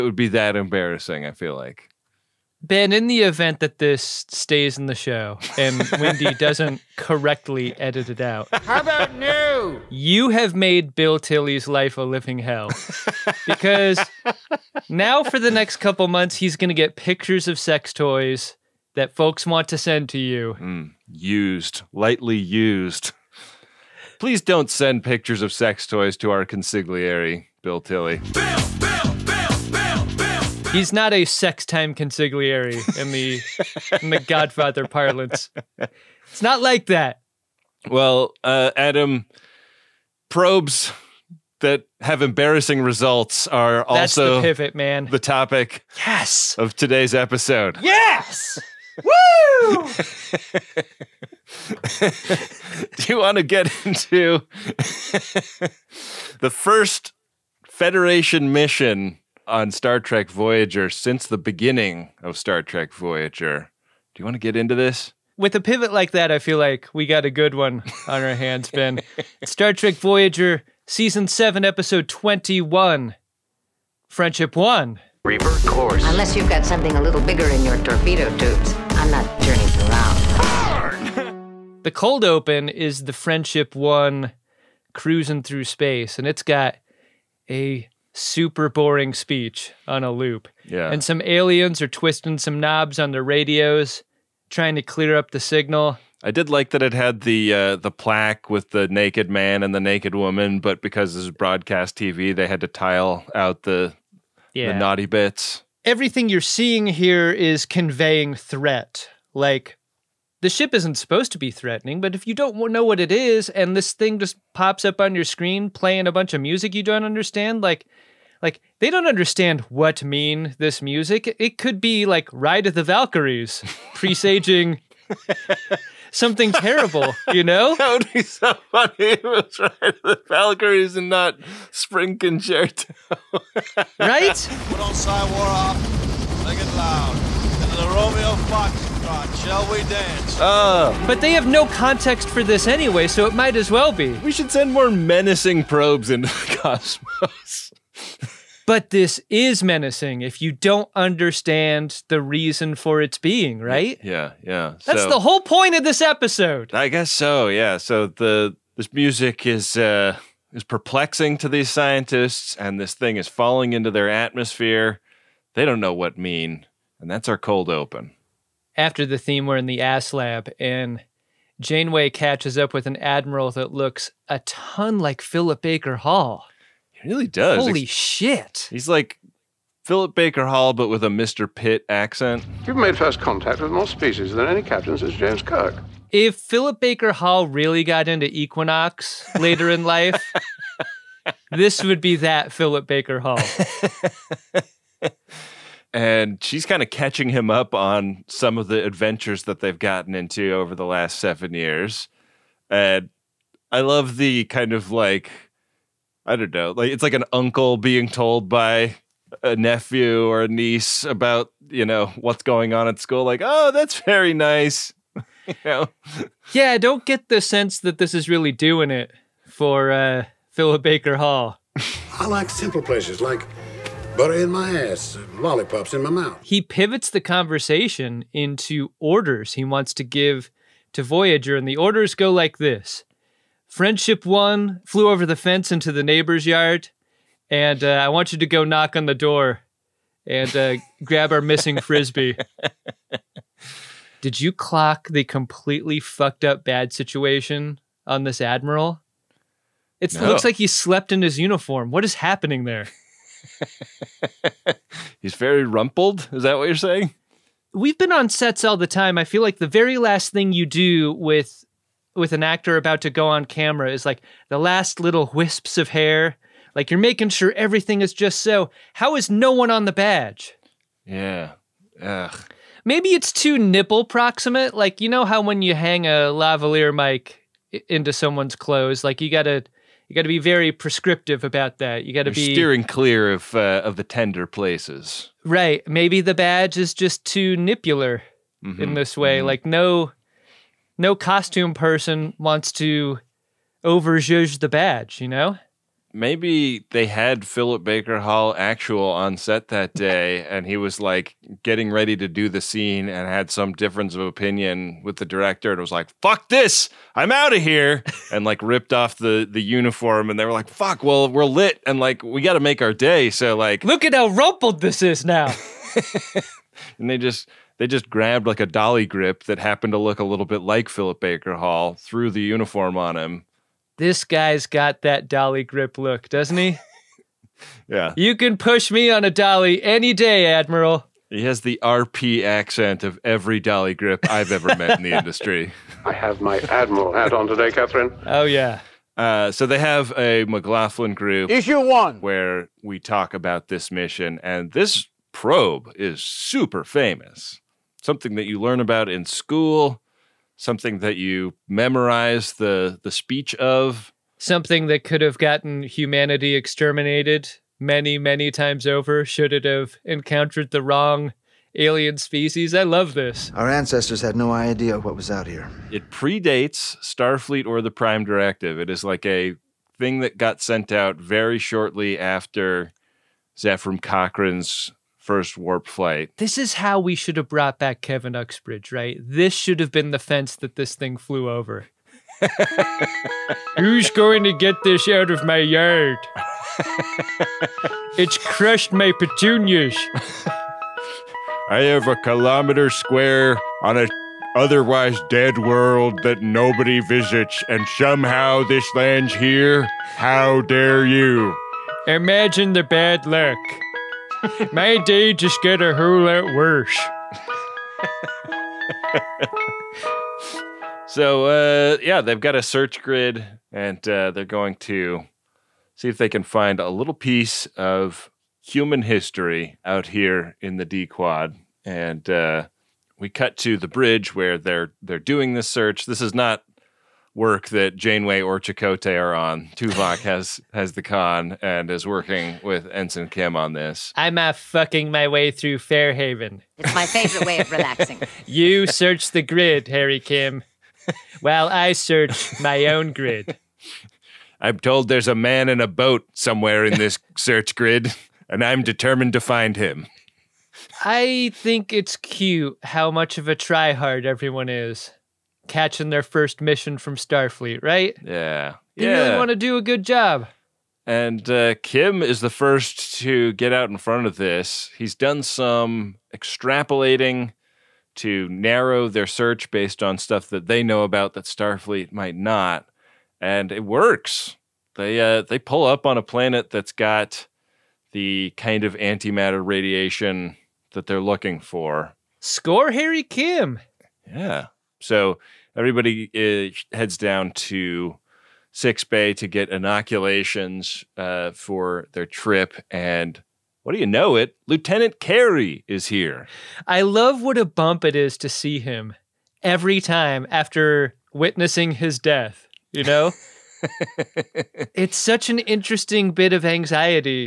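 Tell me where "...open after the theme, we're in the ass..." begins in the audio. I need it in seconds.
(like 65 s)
167 s.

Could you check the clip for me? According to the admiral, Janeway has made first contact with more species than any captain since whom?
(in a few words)
James Kirk.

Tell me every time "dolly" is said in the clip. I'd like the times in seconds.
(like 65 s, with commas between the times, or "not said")
318 s, 325 s, 329 s, 333 s.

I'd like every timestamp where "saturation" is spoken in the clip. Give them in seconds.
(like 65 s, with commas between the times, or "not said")
not said.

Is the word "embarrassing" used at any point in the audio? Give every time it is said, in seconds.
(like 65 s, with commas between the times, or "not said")
0 s, 42 s.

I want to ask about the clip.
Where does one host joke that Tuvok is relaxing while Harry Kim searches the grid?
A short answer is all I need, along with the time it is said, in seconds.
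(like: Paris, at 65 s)
Fairhaven, at 435 s.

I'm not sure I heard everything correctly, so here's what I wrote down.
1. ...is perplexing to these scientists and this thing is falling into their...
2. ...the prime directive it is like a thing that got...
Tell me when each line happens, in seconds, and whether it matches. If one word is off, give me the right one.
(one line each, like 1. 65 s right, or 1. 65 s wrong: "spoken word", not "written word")
1. 160 s right
2. 367 s right.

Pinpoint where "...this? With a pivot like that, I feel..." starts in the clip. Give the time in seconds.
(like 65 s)
64 s.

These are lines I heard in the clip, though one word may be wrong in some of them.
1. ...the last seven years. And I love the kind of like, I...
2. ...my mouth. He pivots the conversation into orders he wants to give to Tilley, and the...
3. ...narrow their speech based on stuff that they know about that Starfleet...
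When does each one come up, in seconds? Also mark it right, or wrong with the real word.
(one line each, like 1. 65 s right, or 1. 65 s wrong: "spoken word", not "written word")
1. 200 s right
2. 226 s wrong: "Voyager", not "Tilley"
3. 468 s wrong: "search", not "speech".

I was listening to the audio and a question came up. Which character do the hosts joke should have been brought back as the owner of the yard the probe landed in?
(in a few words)
Kevin Uxbridge.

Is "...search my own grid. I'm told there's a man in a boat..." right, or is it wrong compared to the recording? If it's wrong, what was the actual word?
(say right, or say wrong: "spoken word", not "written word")
right.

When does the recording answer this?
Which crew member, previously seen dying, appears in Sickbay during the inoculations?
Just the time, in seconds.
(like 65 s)
494 s.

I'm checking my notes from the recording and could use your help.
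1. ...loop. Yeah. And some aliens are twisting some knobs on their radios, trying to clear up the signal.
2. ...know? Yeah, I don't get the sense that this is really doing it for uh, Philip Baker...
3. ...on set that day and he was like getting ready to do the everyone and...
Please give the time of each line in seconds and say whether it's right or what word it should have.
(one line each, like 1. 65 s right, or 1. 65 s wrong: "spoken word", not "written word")
1. 90 s right
2. 215 s right
3. 299 s wrong: "scene", not "everyone".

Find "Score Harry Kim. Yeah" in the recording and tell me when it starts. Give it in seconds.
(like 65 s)
482 s.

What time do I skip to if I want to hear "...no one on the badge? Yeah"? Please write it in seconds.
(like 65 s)
269 s.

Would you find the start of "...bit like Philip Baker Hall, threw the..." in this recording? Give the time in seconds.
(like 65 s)
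320 s.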